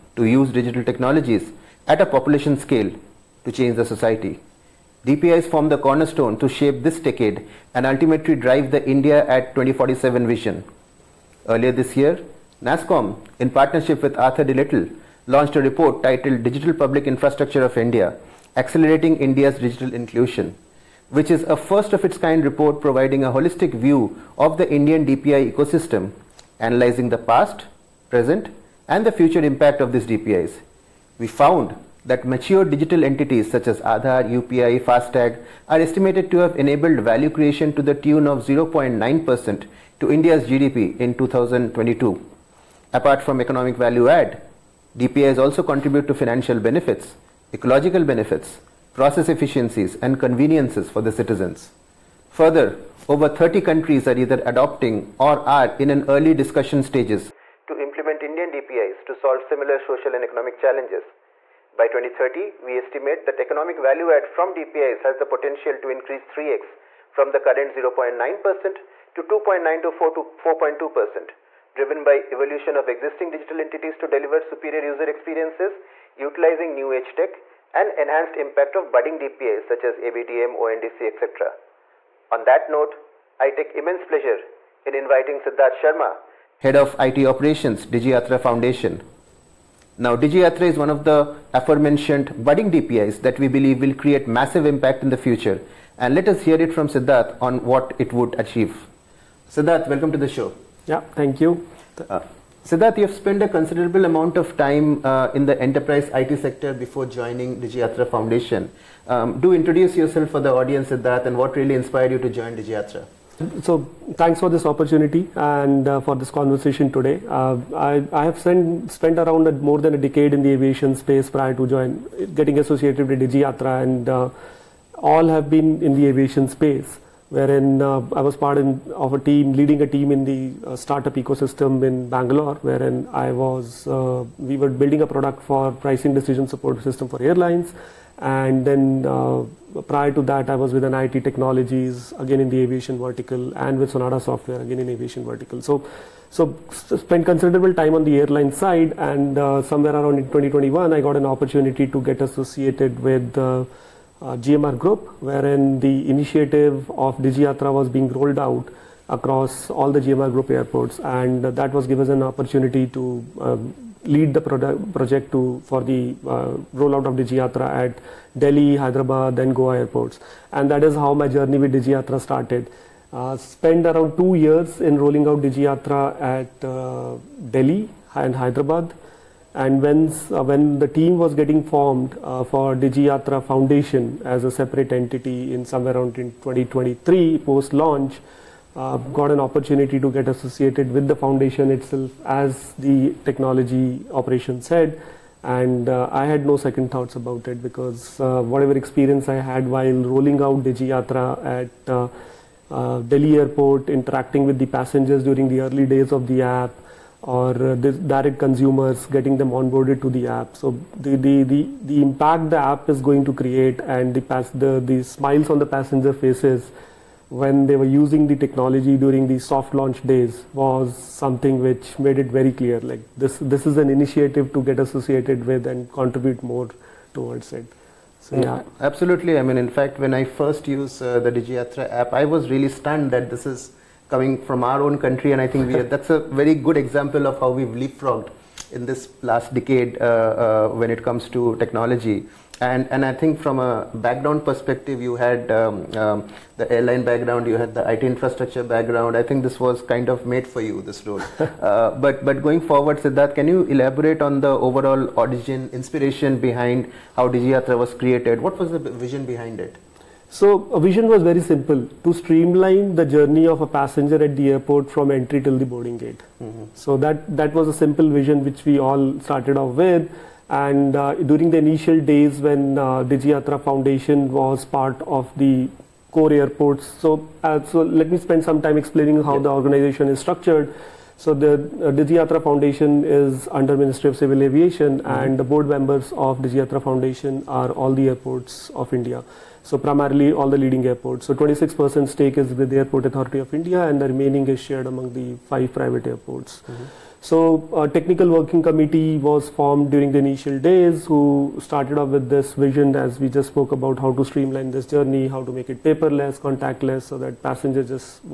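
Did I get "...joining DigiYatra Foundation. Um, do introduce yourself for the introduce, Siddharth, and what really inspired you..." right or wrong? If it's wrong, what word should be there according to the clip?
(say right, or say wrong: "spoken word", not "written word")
wrong: "audience", not "introduce".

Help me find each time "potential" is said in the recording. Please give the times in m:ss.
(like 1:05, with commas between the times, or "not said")
1:05.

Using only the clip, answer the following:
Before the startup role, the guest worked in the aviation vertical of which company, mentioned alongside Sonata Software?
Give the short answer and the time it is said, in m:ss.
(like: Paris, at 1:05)
NIIT Technologies, at 2:20.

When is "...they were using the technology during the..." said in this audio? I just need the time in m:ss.
3:37.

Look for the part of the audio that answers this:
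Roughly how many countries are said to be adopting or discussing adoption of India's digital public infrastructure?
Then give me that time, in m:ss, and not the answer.
0:53.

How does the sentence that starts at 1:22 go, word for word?
On that note, I take immense pleasure in inviting Siddharth Sharma, Head of IT Operations, DigiYatra Foundation.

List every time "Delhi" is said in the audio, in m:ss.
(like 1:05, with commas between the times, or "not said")
2:48, 2:57, 3:23.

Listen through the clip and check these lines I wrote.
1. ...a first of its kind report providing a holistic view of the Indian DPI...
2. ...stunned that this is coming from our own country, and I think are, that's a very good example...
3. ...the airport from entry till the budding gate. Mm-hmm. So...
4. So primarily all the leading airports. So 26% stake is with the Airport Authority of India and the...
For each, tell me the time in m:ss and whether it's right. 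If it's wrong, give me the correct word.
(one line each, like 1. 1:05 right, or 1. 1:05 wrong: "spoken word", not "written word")
1. 0:21 right
2. 3:52 right
3. 4:24 wrong: "boarding", not "budding"
4. 4:49 right.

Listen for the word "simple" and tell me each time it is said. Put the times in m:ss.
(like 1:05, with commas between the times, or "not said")
4:21, 4:27.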